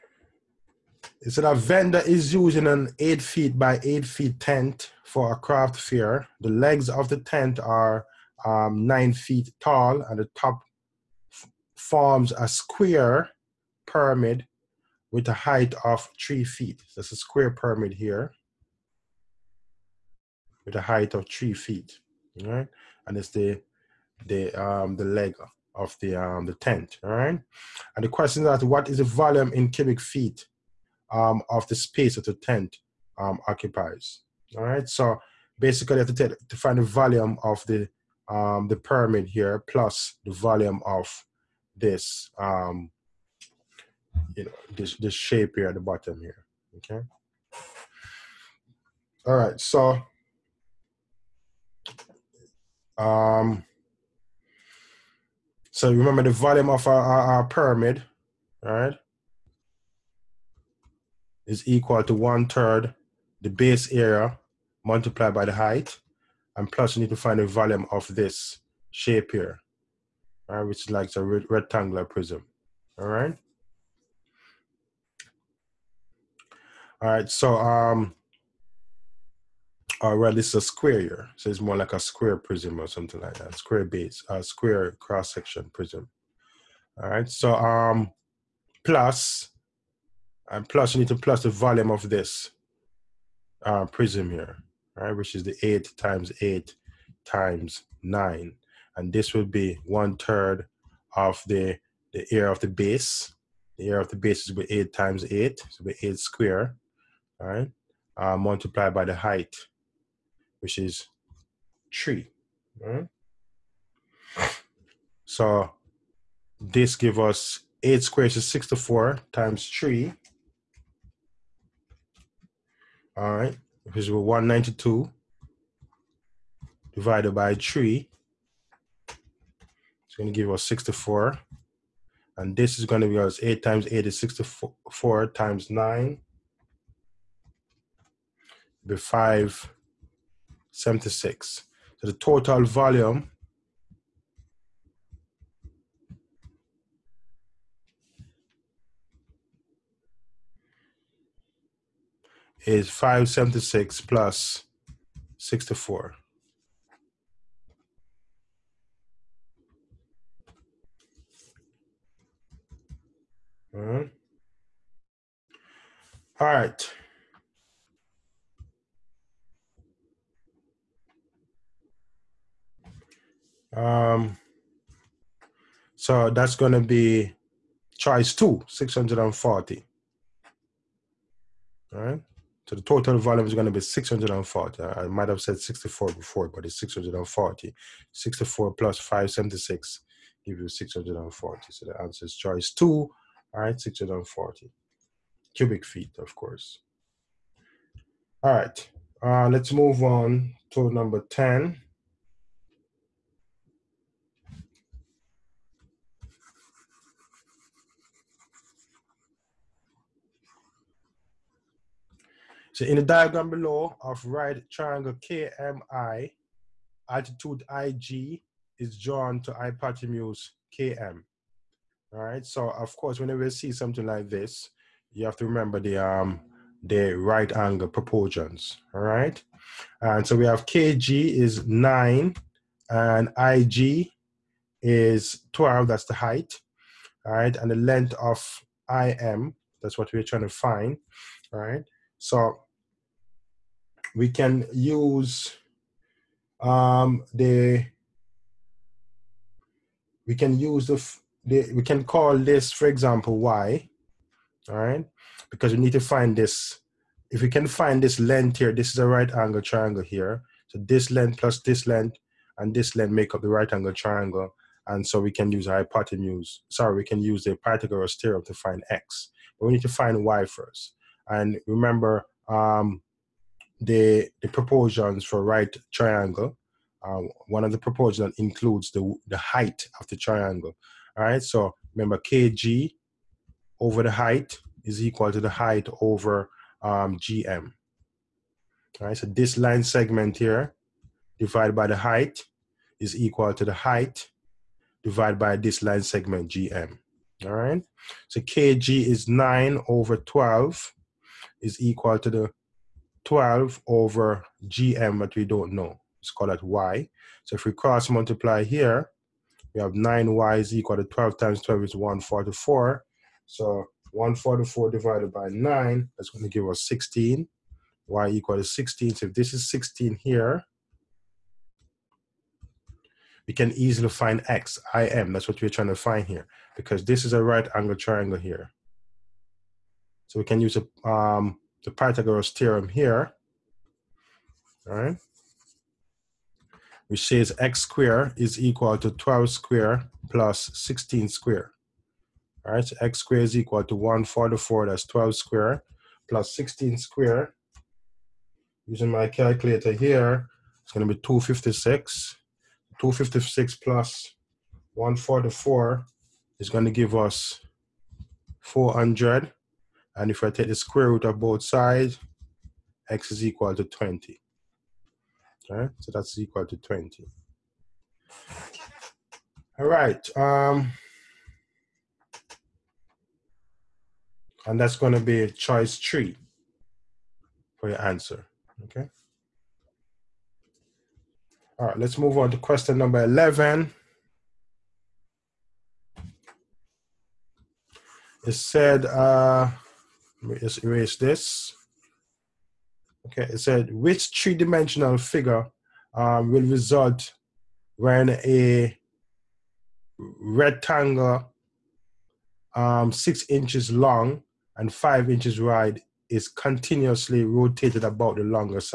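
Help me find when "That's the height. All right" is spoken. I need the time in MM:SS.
03:55.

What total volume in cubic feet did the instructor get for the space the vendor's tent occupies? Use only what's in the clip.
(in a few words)
640.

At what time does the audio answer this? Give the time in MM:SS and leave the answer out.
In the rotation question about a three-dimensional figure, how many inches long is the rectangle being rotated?
06:43.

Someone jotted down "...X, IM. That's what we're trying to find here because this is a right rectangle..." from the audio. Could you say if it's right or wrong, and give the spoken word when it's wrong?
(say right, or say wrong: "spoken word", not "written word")
wrong: "angle", not "rectangle".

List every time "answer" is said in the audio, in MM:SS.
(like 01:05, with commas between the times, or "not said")
03:12, 06:18.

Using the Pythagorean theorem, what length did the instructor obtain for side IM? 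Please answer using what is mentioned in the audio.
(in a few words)
20.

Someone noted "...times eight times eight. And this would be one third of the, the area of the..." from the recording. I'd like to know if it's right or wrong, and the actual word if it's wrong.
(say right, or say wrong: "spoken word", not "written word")
wrong: "nine", not "eight".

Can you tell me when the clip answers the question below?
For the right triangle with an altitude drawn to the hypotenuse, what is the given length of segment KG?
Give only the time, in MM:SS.
03:50.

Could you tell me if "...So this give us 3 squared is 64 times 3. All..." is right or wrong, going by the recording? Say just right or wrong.
wrong.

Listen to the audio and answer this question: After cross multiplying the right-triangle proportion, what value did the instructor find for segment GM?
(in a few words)
16.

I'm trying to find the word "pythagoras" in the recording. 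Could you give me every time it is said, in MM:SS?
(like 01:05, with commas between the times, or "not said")
04:27, 05:31.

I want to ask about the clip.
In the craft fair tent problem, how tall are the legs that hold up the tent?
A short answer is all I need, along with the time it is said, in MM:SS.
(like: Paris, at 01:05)
9 feet, at 00:08.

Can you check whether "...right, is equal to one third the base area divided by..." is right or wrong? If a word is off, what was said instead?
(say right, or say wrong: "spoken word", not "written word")
wrong: "multiplied", not "divided".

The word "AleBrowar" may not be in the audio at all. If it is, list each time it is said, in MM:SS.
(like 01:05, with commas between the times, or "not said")
not said.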